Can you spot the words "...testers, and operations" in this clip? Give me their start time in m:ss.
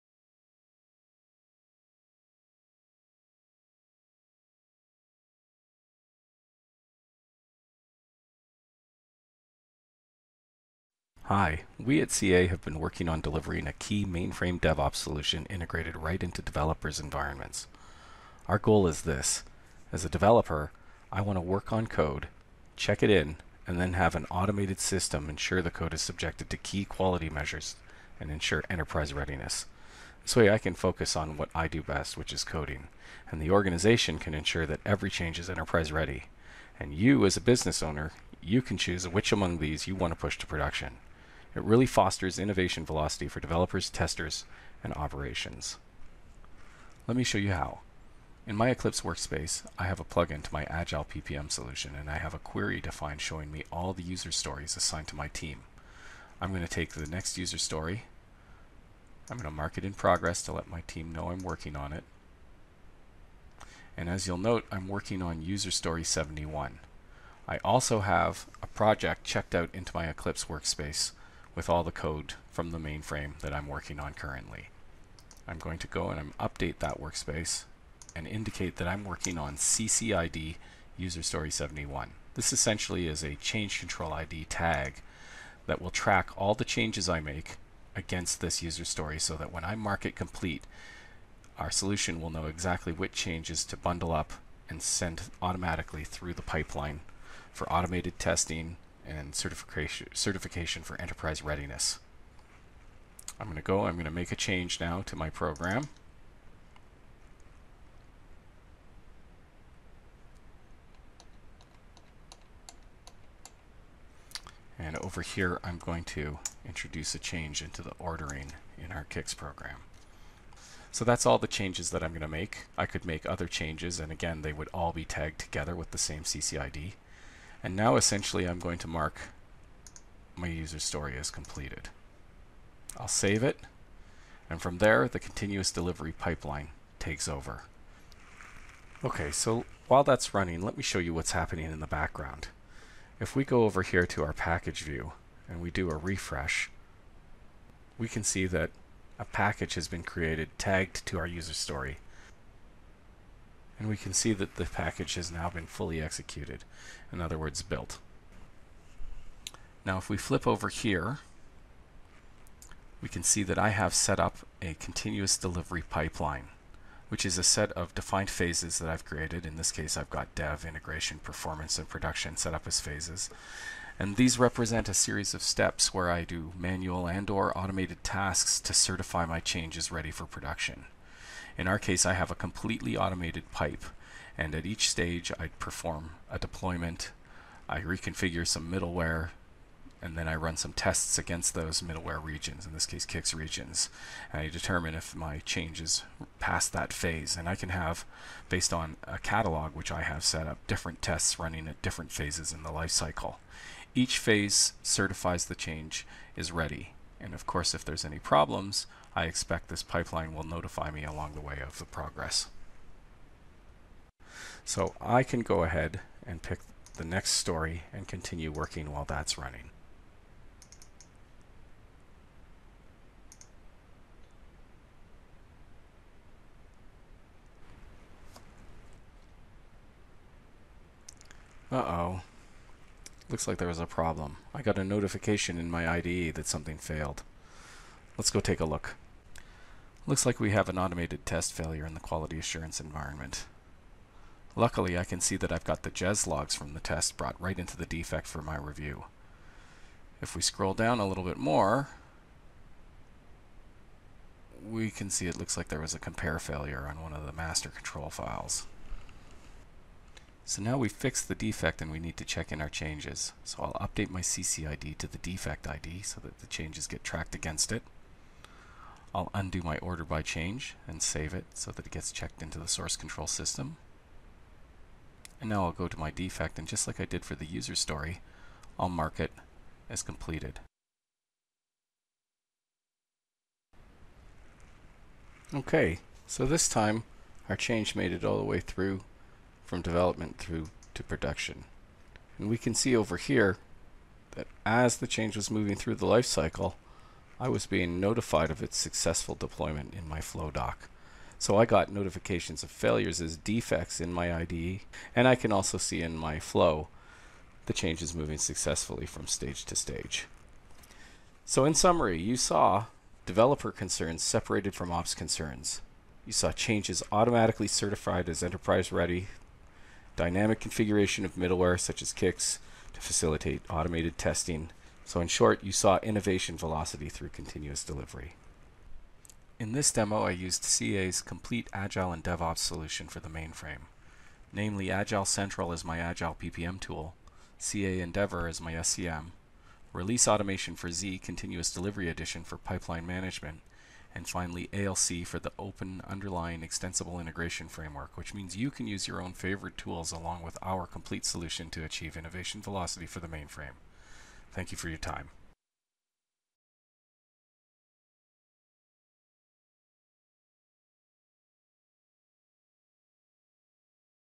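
0:43.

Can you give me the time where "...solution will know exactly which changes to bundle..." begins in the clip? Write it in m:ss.
1:31.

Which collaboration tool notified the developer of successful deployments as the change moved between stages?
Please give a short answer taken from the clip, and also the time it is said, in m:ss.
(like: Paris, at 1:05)
Flowdock, at 5:00.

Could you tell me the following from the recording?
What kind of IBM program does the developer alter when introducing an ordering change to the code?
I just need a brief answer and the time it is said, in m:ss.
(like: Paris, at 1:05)
CICS program, at 1:59.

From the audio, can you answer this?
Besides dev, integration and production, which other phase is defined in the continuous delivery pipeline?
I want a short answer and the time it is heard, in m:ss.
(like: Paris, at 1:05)
Performance, at 2:51.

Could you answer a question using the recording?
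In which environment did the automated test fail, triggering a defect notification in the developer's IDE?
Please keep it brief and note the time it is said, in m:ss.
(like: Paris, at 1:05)
Quality assurance, at 4:01.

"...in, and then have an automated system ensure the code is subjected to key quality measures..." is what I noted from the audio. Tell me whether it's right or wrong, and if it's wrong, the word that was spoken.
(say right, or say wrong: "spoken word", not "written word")
right.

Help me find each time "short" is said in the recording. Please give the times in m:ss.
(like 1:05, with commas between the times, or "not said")
5:25.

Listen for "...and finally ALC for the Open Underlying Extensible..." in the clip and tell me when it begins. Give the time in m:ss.
5:44.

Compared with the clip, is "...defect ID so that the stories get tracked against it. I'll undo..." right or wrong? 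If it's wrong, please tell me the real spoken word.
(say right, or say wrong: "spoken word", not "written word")
wrong: "changes", not "stories".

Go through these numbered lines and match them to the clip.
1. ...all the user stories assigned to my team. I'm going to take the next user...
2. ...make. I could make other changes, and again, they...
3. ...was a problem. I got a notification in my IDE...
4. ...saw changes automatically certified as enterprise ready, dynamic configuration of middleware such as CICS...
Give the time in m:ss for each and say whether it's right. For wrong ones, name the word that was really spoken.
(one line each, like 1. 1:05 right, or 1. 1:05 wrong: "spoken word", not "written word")
1. 0:53 right
2. 2:02 right
3. 3:53 right
4. 5:16 right.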